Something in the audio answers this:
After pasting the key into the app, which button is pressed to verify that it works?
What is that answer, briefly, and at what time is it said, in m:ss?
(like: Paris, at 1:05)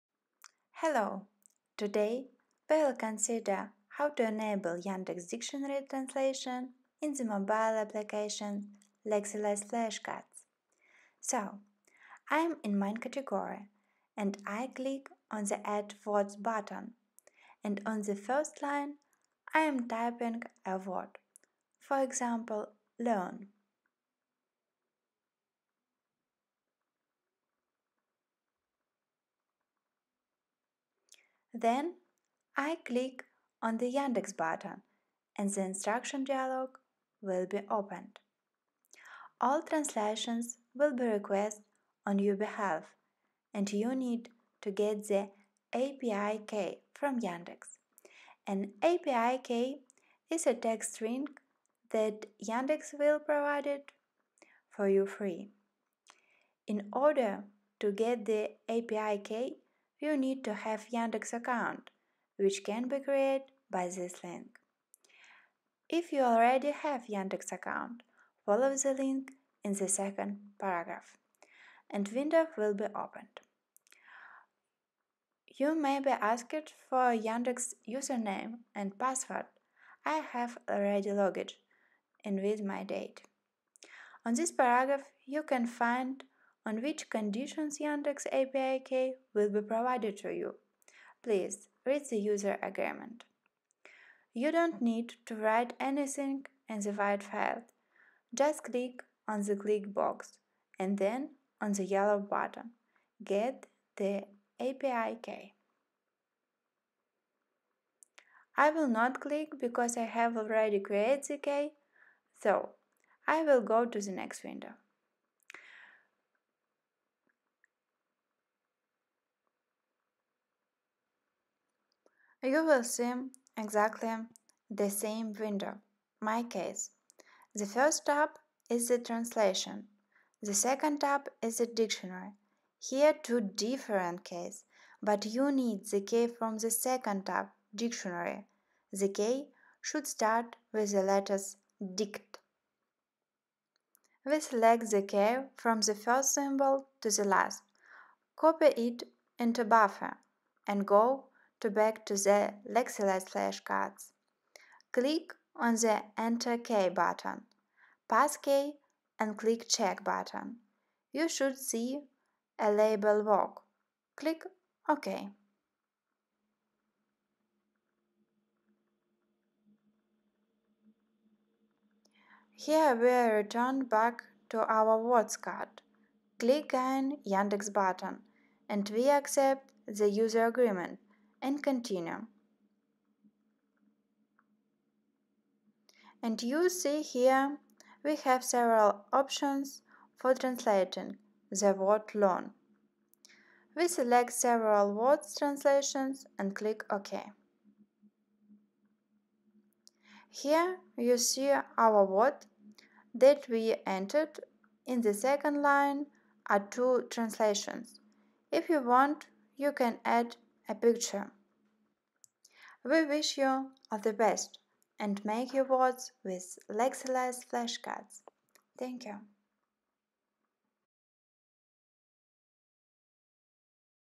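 Check, at 2:39.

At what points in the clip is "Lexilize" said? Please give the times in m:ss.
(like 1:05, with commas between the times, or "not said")
0:09, 2:32, 3:36.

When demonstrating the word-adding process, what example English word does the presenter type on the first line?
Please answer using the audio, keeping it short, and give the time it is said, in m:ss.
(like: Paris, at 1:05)
learn, at 0:22.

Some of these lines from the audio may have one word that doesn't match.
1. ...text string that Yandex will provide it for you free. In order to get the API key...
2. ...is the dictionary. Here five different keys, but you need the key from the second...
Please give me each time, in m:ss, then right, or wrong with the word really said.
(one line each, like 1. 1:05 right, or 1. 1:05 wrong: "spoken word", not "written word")
1. 0:50 right
2. 2:11 wrong: "two", not "five".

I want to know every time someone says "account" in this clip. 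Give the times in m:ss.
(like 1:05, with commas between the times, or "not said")
1:01, 1:07.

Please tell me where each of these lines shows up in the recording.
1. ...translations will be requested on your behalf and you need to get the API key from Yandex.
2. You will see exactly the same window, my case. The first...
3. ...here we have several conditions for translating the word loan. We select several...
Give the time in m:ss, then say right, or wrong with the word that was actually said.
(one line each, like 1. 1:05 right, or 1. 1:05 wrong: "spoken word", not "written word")
1. 0:39 right
2. 2:02 right
3. 3:07 wrong: "options", not "conditions".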